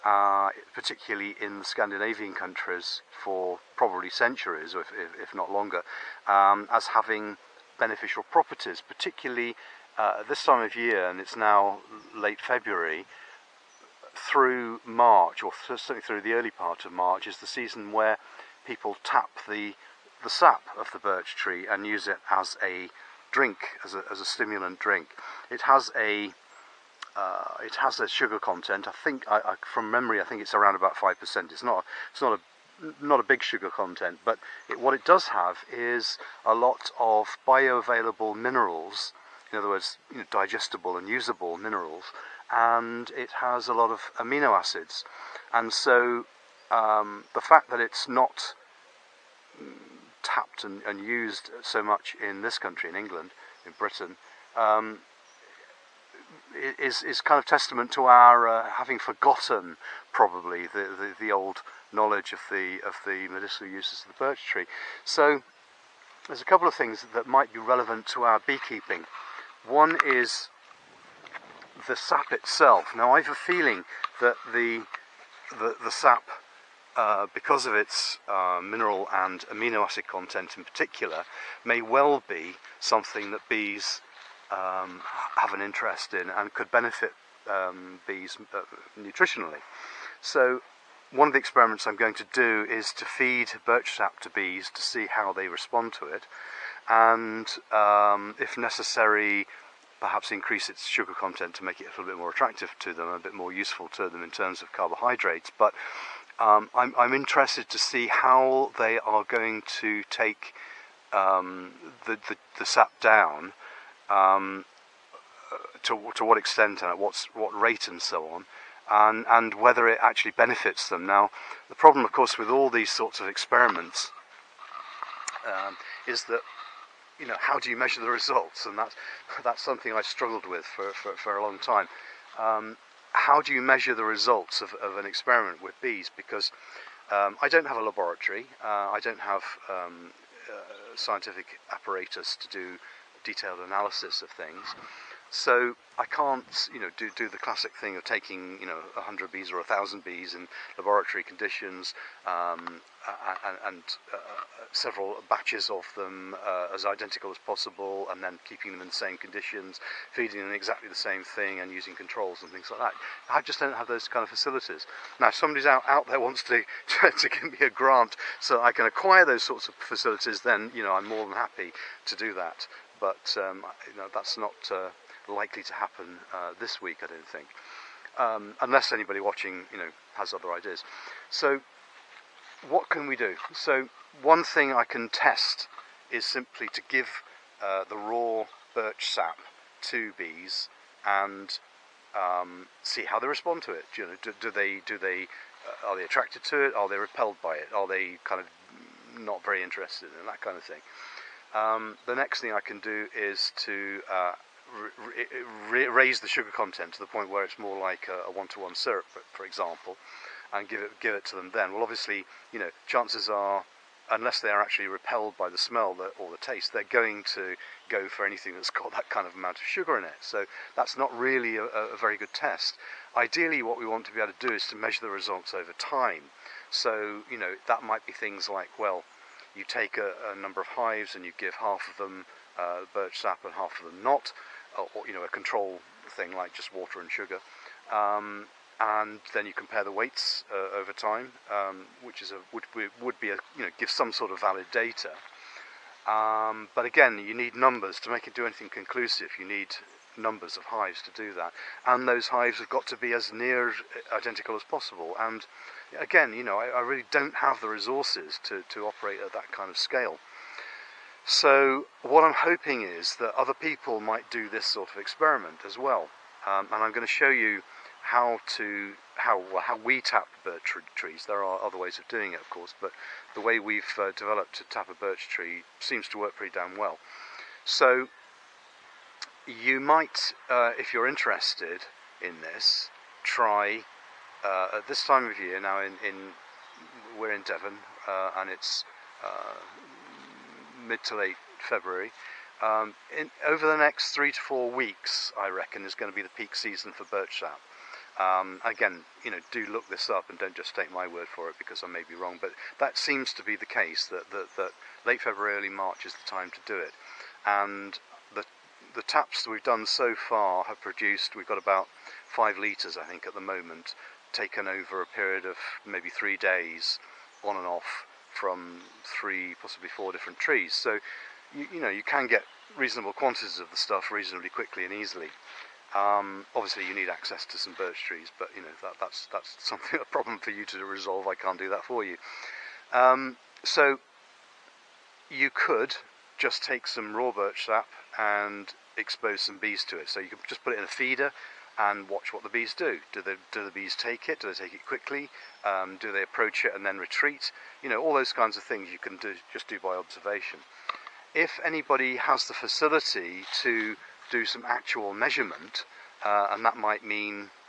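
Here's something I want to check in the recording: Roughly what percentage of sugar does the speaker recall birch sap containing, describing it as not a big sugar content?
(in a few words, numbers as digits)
5%.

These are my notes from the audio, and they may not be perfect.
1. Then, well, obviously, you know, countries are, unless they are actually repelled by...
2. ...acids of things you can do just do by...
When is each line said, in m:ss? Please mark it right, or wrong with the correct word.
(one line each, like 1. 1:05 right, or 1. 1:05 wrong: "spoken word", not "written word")
1. 3:31 wrong: "chances", not "countries"
2. 5:48 wrong: "kinds", not "acids".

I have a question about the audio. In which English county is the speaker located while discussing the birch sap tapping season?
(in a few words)
Devon.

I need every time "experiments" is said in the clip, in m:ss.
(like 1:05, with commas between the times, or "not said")
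1:31, 2:03, 2:15, 4:24.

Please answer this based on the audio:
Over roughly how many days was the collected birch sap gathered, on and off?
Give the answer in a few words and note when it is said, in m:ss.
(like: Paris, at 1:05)
3 days, at 5:16.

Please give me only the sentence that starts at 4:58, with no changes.
Um, again, you know, do look this up and don't just take my word for it because I may be wrong.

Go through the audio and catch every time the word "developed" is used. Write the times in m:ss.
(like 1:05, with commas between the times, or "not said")
4:34.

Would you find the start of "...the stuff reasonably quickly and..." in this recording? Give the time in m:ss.
5:23.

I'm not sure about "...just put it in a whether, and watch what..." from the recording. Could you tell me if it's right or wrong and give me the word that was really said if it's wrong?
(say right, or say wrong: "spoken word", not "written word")
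wrong: "feeder", not "whether".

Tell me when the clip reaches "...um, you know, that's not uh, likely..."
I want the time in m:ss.
2:53.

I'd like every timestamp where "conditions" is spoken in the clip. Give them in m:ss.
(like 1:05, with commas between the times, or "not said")
2:31, 2:39.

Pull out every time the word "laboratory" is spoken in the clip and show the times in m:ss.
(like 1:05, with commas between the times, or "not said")
2:17, 2:30.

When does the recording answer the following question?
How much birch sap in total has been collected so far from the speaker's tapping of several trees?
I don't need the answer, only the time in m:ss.
5:12.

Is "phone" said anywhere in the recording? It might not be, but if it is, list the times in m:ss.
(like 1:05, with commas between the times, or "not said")
not said.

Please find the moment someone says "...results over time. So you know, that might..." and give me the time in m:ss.
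3:45.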